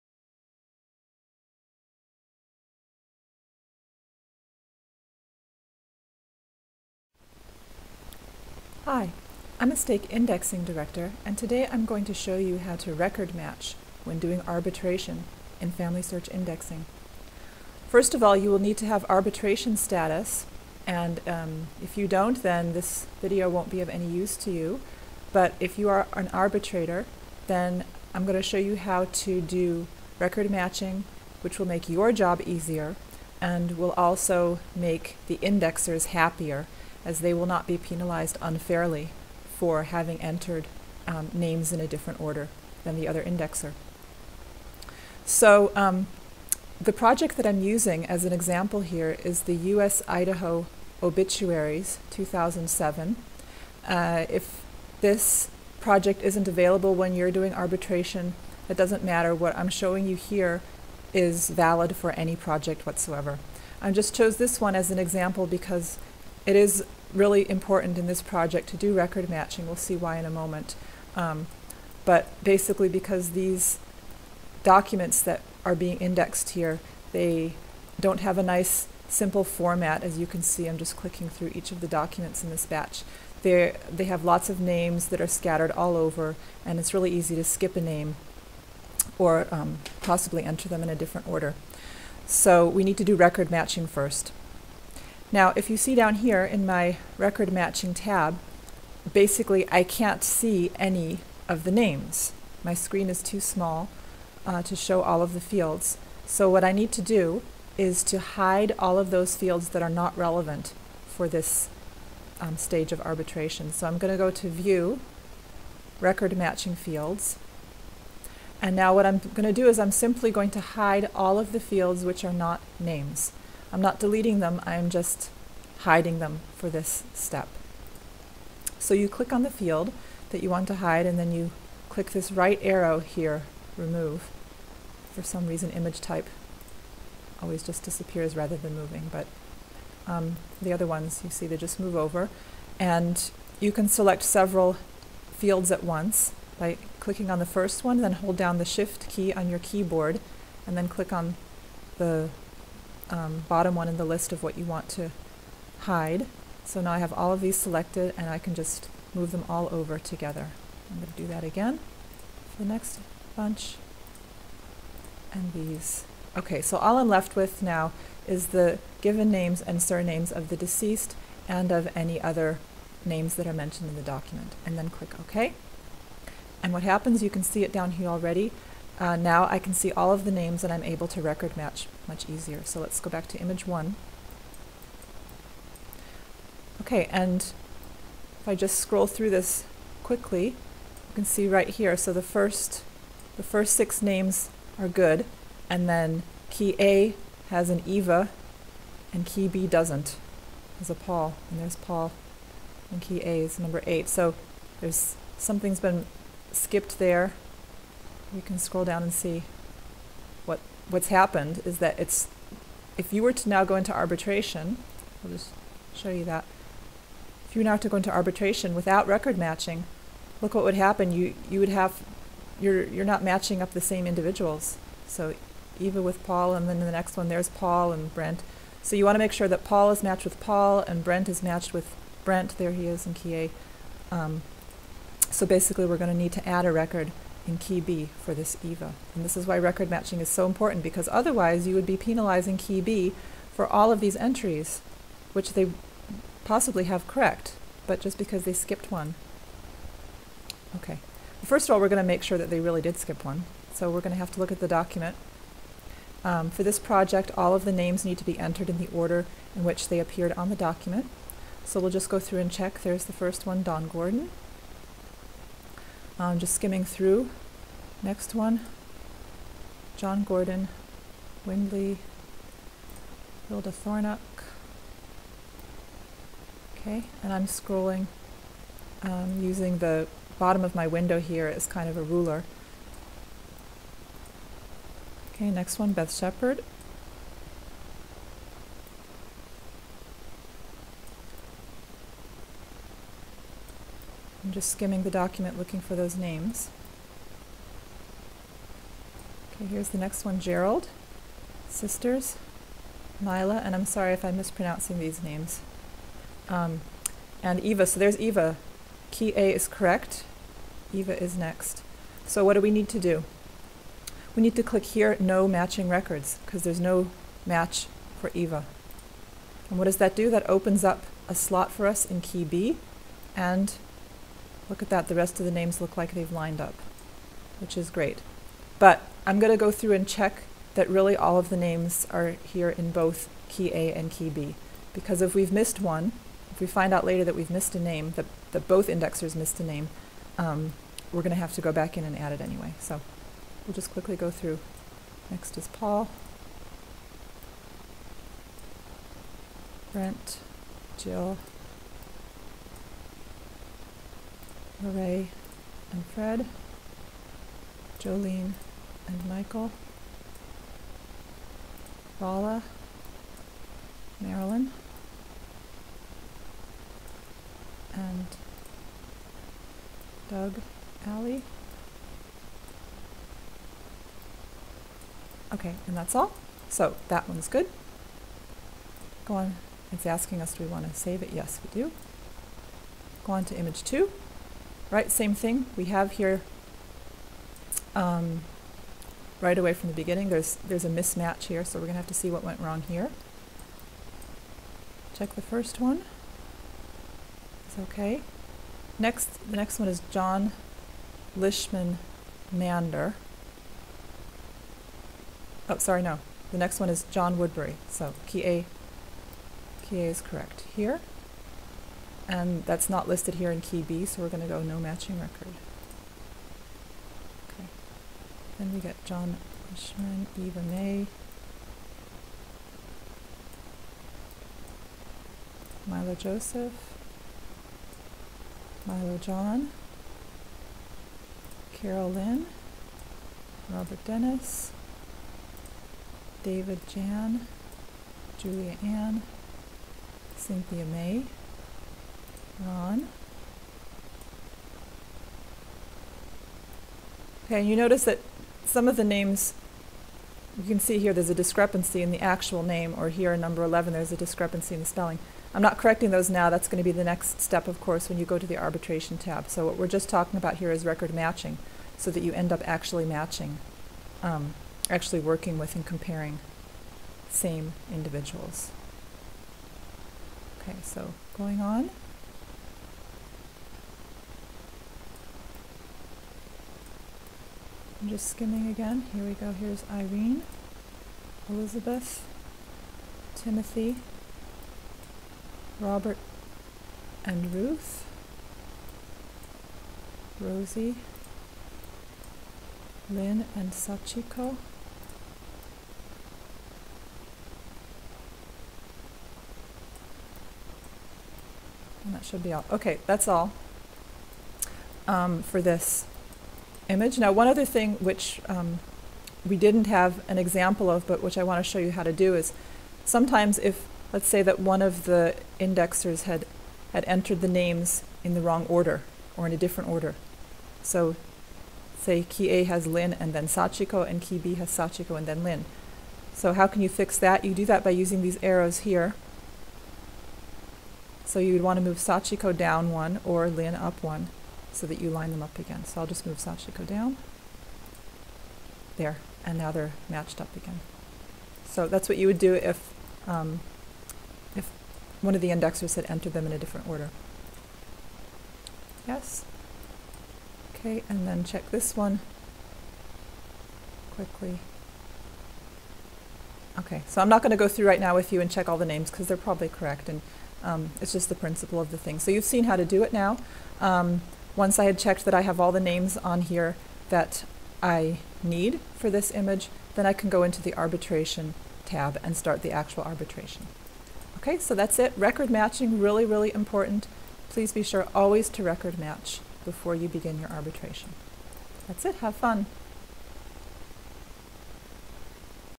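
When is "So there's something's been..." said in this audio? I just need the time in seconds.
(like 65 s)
204 s.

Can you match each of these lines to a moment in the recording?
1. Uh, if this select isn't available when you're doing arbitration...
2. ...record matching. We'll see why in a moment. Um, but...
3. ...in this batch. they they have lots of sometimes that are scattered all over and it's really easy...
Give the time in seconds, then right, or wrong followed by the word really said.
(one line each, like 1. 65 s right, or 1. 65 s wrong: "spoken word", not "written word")
1. 53 s wrong: "project", not "select"
2. 68 s right
3. 82 s wrong: "names", not "sometimes".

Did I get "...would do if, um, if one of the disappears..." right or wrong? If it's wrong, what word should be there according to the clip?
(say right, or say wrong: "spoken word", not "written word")
wrong: "indexers", not "disappears".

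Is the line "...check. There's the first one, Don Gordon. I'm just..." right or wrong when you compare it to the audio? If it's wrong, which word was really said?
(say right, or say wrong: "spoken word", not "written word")
right.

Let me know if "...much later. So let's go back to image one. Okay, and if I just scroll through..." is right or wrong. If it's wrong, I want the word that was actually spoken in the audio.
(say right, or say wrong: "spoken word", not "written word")
wrong: "easier", not "later".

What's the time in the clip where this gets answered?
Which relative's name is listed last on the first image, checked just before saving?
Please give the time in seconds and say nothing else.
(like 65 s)
370 s.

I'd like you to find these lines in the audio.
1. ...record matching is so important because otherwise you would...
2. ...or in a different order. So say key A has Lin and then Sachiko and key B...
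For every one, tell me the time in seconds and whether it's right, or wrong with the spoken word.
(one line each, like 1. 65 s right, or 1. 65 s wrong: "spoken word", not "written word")
1. 239 s right
2. 519 s right.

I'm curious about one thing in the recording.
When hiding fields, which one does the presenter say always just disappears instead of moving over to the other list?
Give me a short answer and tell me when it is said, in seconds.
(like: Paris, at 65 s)
image type, at 135 s.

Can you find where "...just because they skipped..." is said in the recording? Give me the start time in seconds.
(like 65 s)
247 s.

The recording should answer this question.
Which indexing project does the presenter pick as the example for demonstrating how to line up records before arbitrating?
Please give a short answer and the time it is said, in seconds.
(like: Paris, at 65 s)
U.S. Idaho Obituaries 2007, at 49 s.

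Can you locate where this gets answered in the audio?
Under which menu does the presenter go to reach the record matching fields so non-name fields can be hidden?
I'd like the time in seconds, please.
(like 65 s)
114 s.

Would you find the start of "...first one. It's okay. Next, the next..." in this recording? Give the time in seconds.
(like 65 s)
395 s.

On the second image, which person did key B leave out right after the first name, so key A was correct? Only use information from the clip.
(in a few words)
John Woodbury.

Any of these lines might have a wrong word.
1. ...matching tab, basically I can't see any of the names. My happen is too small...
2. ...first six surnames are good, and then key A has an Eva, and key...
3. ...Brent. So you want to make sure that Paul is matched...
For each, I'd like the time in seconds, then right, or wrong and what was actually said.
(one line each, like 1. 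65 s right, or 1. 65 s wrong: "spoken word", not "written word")
1. 97 s wrong: "screen", not "happen"
2. 193 s wrong: "names", not "surnames"
3. 228 s right.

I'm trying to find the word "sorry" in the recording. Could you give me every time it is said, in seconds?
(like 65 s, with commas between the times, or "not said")
303 s, 405 s.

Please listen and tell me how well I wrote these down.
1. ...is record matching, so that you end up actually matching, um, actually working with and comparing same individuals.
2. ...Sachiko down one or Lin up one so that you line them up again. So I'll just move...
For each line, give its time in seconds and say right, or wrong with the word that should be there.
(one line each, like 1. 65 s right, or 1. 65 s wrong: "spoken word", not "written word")
1. 460 s right
2. 531 s right.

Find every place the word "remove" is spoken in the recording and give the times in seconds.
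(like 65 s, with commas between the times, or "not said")
133 s.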